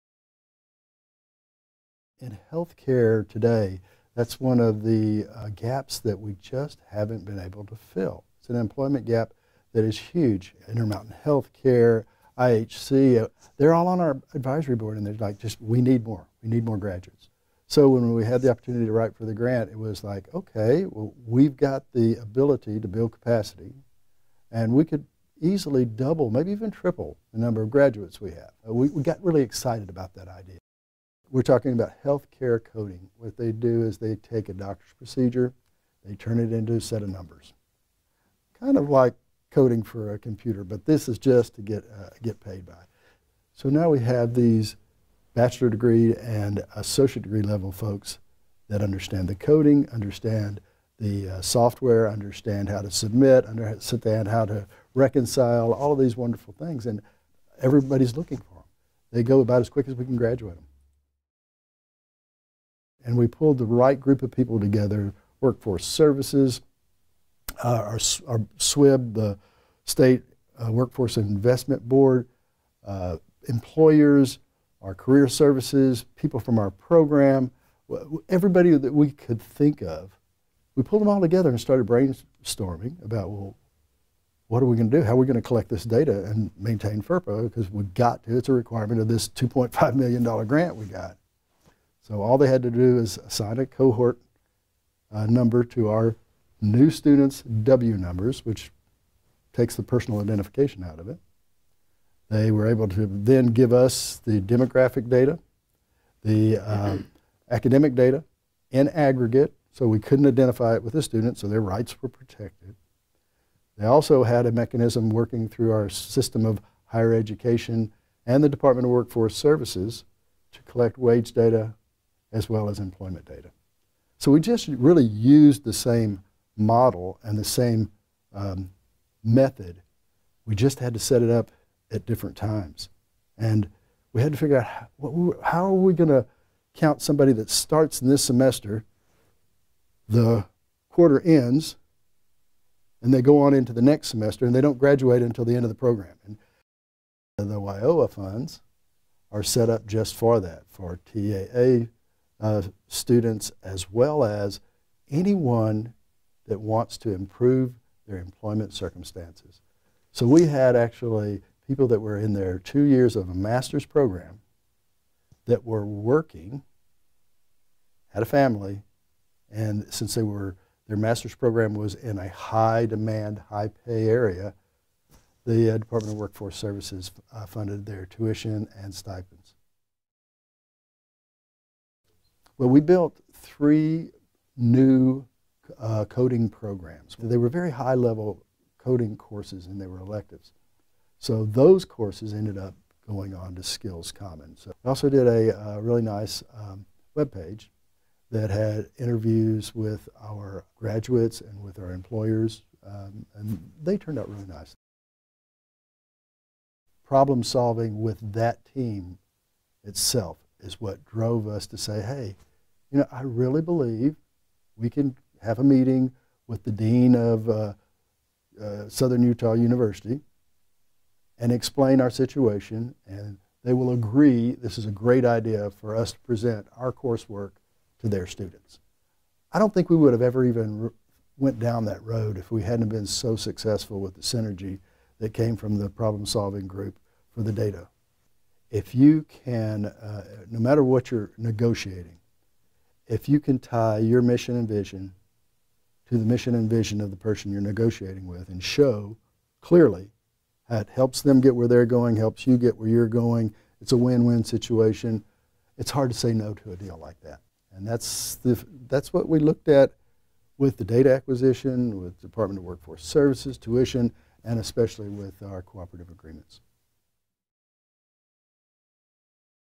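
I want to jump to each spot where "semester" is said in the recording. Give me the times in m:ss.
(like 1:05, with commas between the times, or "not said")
2:18, 2:24.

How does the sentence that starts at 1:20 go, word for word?
We pulled them all together and started brainstorming about, well, what are we going to do?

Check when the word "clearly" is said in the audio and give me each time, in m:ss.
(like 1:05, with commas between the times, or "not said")
4:09.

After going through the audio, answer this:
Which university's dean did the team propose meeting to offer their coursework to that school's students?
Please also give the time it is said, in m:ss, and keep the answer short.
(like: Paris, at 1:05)
Southern Utah University, at 3:38.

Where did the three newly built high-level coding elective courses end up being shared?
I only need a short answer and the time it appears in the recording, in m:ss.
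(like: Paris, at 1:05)
SkillsCommons, at 3:13.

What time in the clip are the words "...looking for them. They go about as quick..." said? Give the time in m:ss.
0:58.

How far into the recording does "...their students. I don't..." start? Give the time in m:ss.
3:48.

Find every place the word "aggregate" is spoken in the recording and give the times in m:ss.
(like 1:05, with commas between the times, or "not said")
1:48.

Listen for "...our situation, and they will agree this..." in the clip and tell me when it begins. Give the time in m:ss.
3:42.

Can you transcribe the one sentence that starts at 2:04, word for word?
So we just really used the same model and the same um, method.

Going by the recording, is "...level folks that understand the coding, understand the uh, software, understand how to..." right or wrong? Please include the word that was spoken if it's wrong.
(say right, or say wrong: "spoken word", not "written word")
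right.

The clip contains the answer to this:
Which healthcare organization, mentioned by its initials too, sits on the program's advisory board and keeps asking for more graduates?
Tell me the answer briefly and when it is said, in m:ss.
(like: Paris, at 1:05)
Intermountain Healthcare, at 0:10.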